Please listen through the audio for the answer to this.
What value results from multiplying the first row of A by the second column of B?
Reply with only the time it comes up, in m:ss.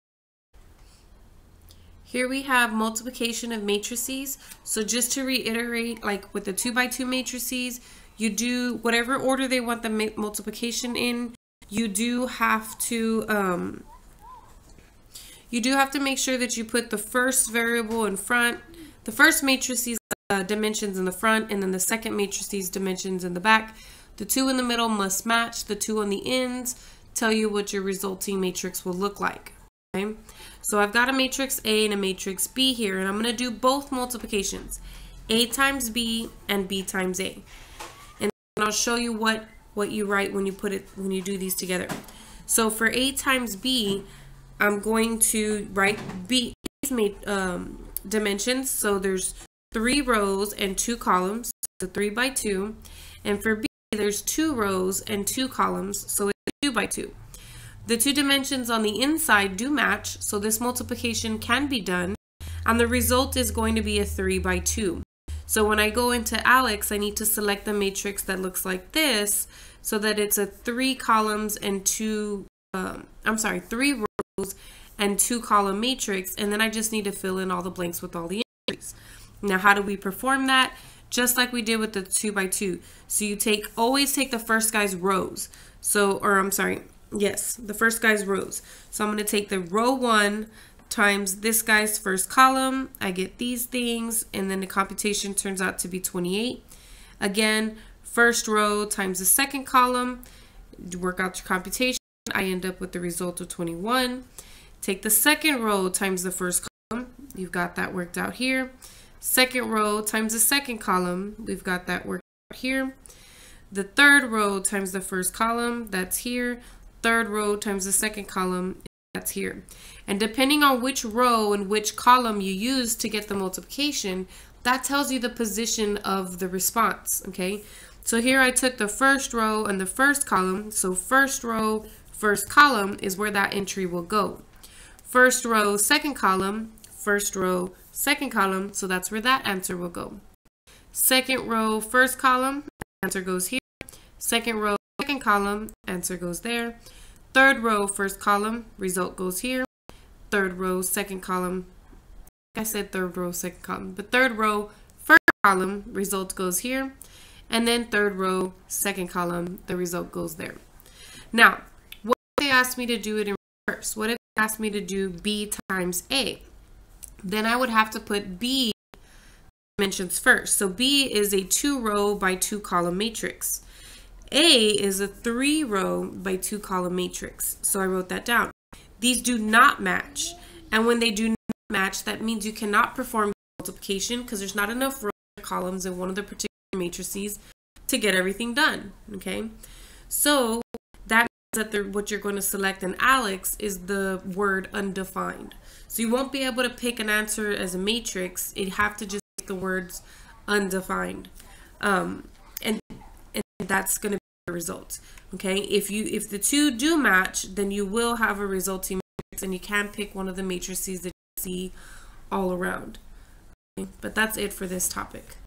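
1:43.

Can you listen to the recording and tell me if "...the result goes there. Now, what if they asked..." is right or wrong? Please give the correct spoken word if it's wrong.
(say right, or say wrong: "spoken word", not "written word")
right.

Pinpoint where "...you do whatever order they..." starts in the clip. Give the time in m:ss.
0:08.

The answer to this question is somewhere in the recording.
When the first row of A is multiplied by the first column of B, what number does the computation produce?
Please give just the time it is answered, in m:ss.
1:35.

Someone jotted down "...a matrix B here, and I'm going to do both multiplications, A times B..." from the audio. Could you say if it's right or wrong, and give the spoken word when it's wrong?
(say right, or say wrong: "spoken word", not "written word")
right.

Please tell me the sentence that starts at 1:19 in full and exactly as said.
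Now how do we perform that?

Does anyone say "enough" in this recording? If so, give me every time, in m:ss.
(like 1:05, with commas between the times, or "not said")
3:04.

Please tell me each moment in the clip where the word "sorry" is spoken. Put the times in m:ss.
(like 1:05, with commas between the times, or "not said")
1:13, 1:26.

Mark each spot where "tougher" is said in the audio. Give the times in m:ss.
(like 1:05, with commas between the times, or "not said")
not said.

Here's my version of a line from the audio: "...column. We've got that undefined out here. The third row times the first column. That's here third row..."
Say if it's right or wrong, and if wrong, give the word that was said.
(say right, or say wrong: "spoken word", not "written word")
wrong: "worked", not "undefined".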